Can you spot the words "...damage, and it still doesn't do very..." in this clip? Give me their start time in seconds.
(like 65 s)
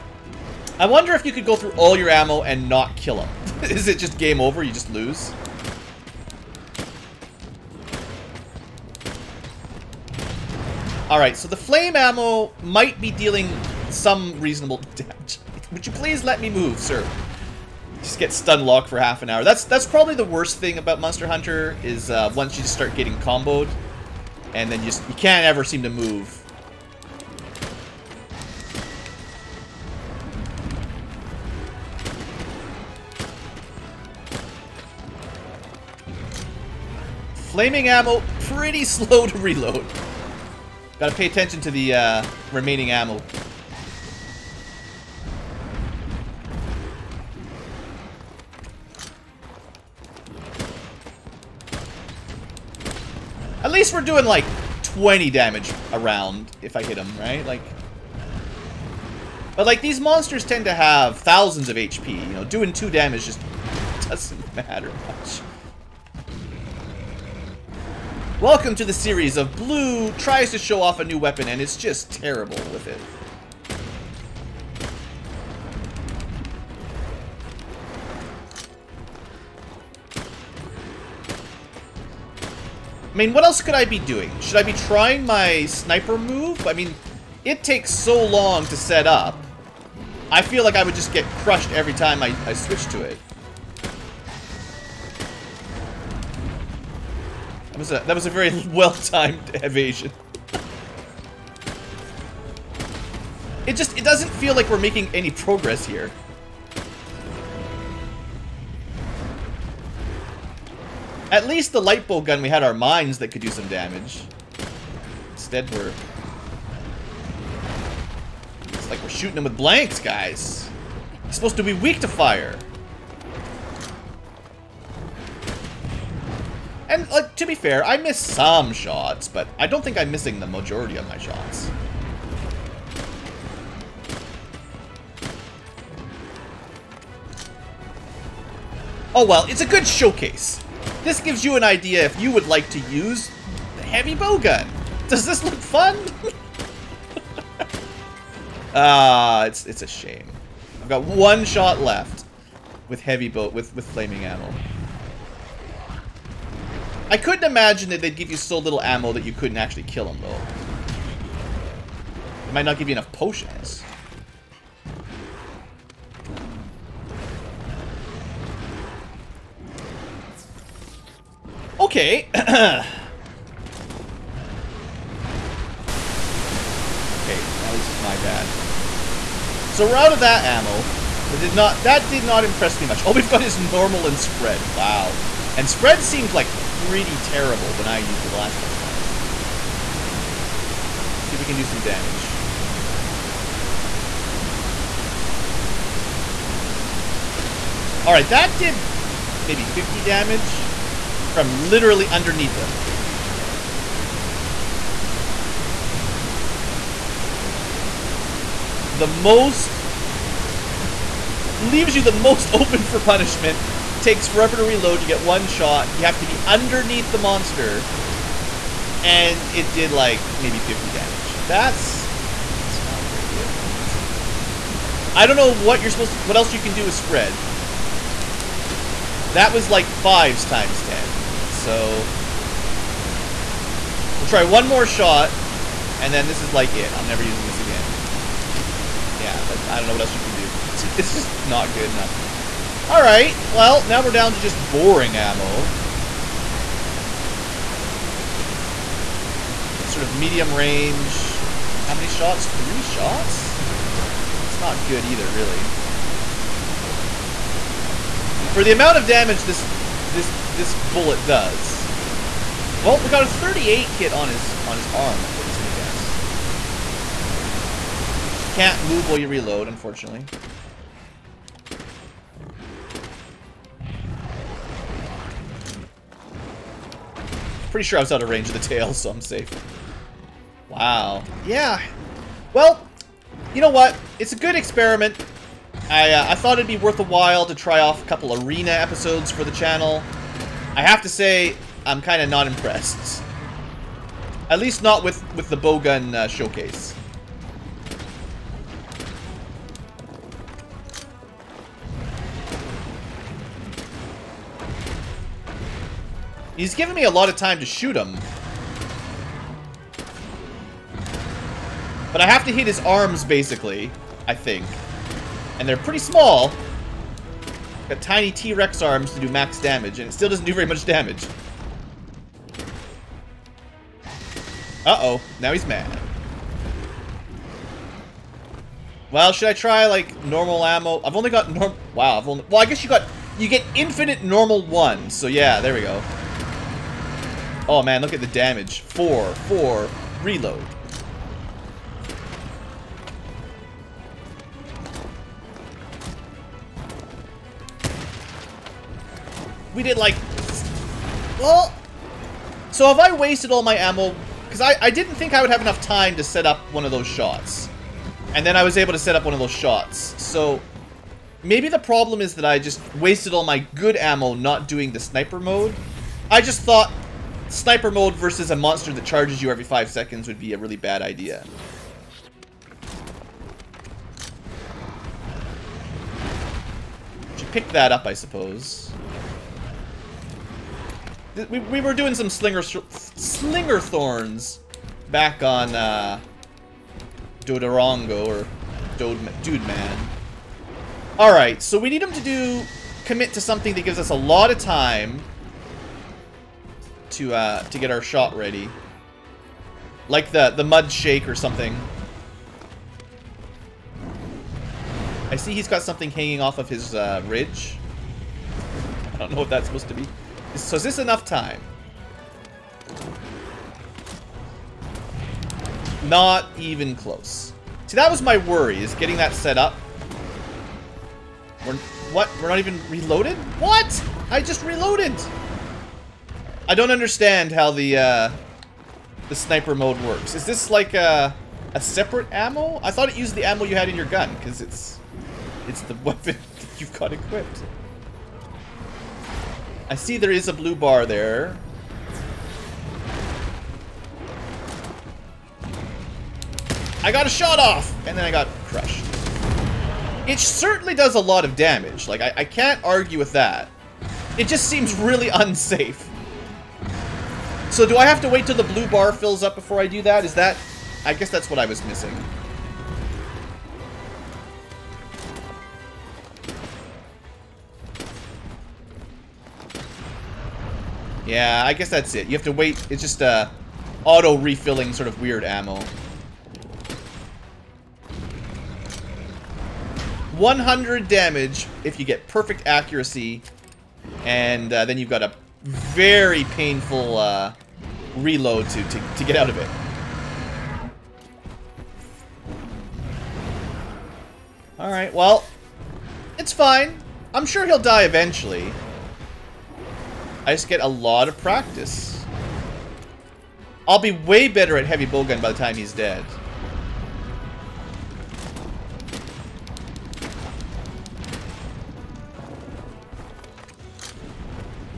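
319 s.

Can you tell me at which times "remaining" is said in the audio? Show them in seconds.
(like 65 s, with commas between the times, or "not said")
42 s.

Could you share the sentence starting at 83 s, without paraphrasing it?
I mean, what else could I be doing?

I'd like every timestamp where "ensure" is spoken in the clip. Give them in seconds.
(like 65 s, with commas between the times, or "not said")
not said.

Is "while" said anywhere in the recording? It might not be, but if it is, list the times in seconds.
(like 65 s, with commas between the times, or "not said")
269 s, 287 s.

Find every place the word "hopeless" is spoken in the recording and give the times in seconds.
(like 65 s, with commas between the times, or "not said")
not said.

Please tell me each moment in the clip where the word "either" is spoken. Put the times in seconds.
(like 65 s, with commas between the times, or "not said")
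255 s.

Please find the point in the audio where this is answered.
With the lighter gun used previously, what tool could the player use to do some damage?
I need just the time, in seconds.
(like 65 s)
112 s.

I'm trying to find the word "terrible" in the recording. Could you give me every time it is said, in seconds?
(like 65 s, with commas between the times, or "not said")
72 s, 187 s.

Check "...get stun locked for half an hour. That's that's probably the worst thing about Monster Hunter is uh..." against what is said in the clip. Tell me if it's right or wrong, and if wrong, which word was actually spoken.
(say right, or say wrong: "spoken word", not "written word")
right.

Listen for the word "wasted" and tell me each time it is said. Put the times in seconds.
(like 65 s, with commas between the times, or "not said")
353 s, 362 s.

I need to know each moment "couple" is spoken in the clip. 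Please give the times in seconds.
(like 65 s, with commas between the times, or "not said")
188 s, 288 s.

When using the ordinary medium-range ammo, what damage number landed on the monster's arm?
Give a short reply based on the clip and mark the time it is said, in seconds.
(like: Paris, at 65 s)
38, at 263 s.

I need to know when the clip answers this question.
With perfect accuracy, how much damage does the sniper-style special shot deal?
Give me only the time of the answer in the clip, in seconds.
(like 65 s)
480 s.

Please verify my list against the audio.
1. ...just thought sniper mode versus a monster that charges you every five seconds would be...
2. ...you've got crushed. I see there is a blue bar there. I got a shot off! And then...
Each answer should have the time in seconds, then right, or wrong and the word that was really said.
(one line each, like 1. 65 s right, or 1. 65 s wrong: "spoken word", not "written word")
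1. 366 s right
2. 436 s wrong: "equipped", not "crushed".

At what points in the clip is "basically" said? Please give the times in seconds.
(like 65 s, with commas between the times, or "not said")
313 s.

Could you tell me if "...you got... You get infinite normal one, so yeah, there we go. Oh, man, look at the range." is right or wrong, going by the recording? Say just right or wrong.
wrong.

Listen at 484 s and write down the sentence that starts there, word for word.
And uh, then you've got a very painful uh, reload to, to, to get out of it.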